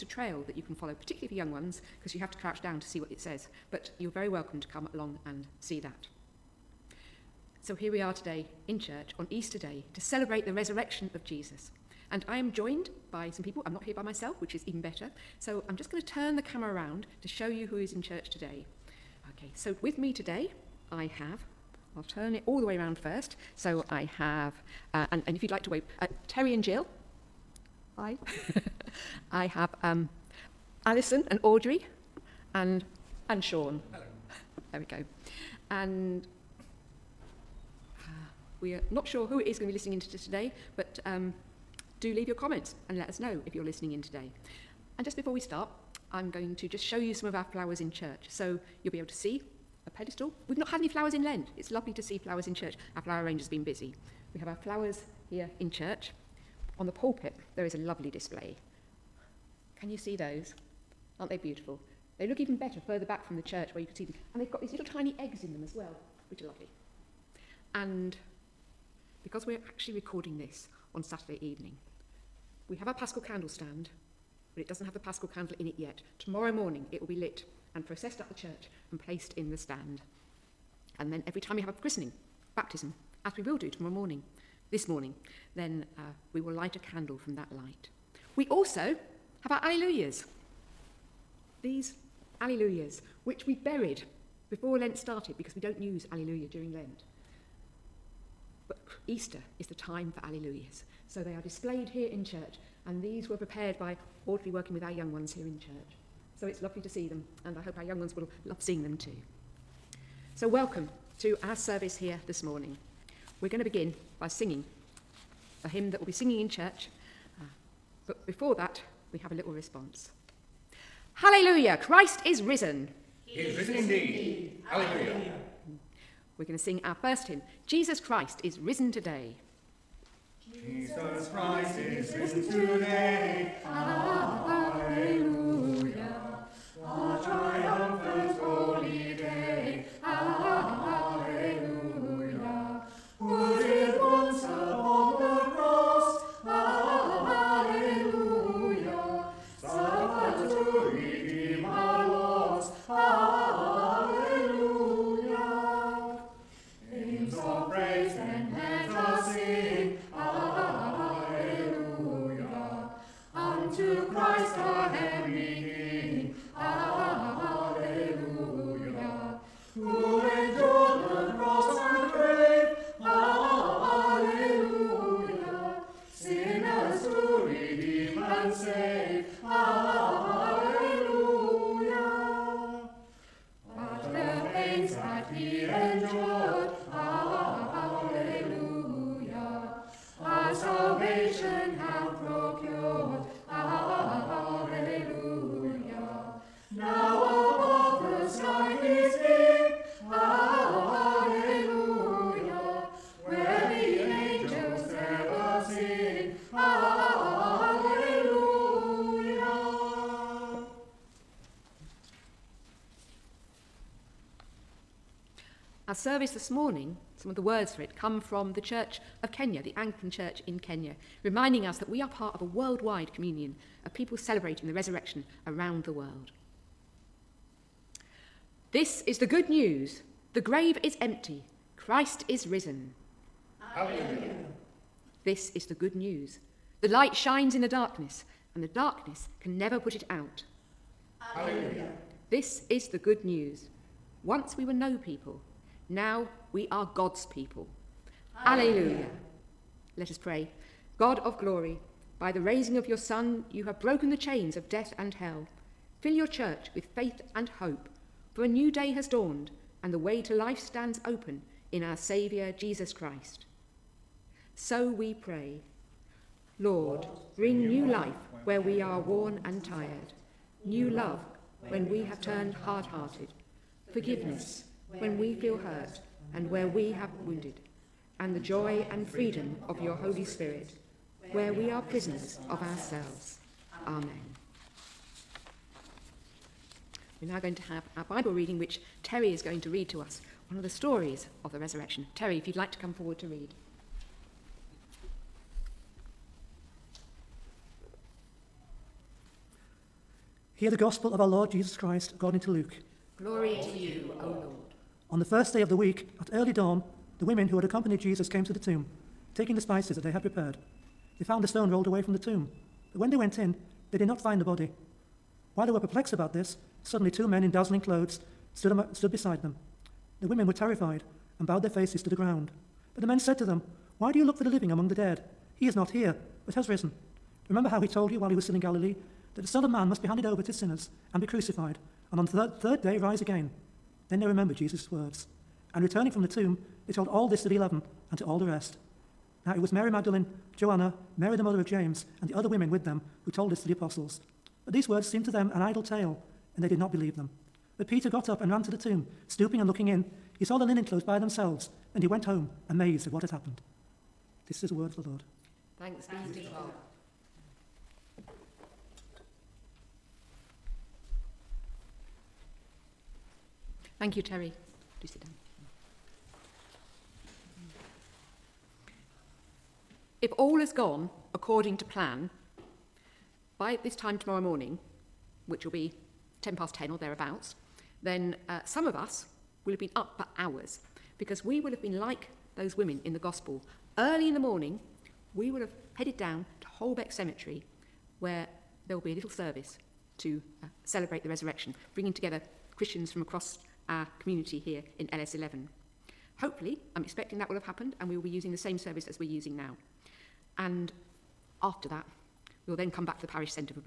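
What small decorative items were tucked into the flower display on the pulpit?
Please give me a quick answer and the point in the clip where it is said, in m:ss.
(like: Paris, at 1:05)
tiny eggs, at 1:04.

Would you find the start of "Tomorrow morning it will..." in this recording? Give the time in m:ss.
1:16.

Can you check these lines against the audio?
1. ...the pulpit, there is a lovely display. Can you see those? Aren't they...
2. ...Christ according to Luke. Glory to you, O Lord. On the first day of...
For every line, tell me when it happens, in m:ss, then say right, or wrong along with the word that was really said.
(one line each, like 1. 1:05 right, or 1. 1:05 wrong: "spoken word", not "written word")
1. 0:56 right
2. 5:01 right.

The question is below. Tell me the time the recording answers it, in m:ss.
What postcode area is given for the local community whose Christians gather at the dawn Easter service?
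6:35.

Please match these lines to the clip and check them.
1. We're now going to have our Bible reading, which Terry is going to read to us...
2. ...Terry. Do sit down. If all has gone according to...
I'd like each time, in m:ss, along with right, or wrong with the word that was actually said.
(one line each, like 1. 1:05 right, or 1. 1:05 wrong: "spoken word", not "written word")
1. 4:47 right
2. 6:04 right.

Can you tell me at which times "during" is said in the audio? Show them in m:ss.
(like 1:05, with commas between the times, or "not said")
1:36.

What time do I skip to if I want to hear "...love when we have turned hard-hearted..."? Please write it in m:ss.
4:30.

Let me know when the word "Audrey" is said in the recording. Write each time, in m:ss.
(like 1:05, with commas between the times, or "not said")
0:31, 1:44.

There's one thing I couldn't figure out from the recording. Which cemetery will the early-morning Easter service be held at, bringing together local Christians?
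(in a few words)
Holbeck Cemetery.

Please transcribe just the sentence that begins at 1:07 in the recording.
And because we're actually recording this on Saturday evening.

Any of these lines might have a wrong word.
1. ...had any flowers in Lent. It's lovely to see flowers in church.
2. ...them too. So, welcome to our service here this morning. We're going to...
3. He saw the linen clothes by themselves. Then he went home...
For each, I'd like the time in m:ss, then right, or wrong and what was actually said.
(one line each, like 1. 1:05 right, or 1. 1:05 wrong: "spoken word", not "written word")
1. 0:50 right
2. 1:48 right
3. 5:50 right.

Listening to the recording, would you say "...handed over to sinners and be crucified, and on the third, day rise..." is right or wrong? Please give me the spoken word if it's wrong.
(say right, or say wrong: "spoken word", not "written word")
right.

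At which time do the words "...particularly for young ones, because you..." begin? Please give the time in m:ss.
0:00.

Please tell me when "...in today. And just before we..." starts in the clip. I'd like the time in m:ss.
0:43.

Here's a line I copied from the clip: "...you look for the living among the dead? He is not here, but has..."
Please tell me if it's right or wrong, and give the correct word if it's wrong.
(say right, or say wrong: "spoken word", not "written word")
right.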